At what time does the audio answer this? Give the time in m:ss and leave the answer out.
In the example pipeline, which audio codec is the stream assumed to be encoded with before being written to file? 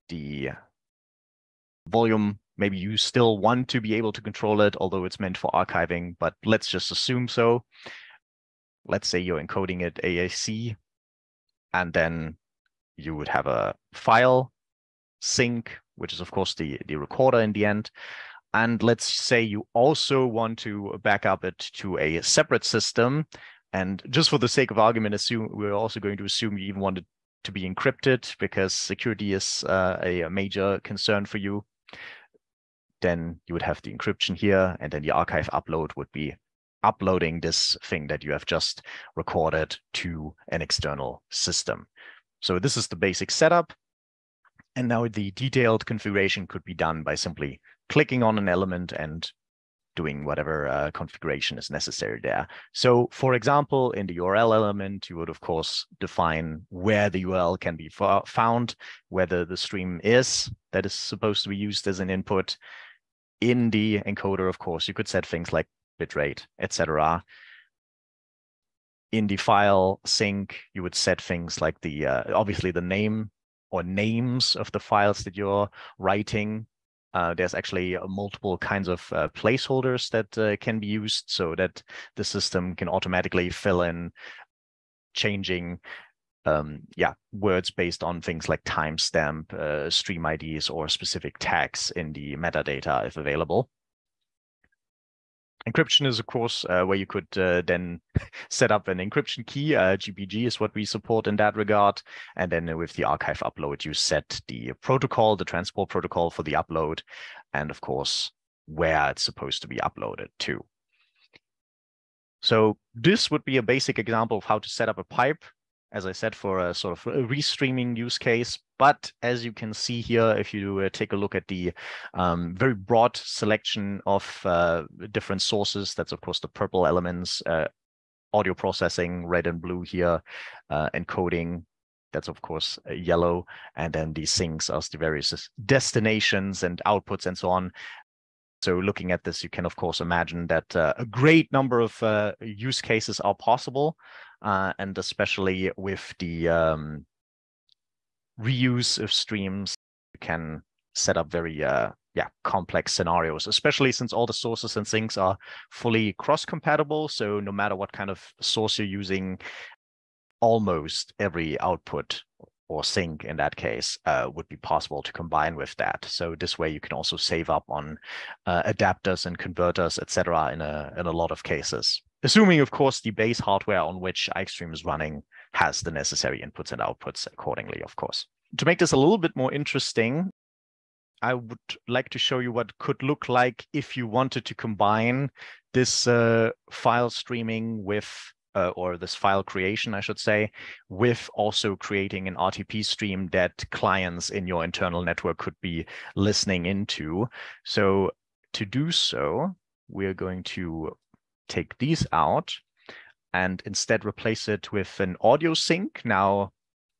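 0:10.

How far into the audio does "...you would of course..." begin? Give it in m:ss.
0:55.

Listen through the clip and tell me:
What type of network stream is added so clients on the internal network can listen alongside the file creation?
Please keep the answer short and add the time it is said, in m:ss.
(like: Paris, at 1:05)
RTP stream, at 3:12.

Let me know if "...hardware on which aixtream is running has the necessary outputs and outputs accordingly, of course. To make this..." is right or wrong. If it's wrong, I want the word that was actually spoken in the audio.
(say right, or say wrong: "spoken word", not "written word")
wrong: "inputs", not "outputs".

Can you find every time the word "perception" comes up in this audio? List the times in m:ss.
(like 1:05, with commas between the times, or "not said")
not said.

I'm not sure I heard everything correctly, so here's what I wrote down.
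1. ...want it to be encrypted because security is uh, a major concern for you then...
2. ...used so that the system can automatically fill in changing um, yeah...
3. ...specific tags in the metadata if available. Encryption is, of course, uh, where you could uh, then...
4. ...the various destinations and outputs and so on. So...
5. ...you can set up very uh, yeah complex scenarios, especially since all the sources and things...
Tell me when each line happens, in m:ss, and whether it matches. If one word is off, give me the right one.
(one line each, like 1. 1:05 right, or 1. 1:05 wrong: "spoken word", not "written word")
1. 0:26 right
2. 1:20 right
3. 1:30 right
4. 2:14 right
5. 2:30 right.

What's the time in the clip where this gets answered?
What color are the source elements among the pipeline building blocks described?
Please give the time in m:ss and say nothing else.
2:06.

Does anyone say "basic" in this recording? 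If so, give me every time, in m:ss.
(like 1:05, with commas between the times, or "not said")
0:42, 1:53.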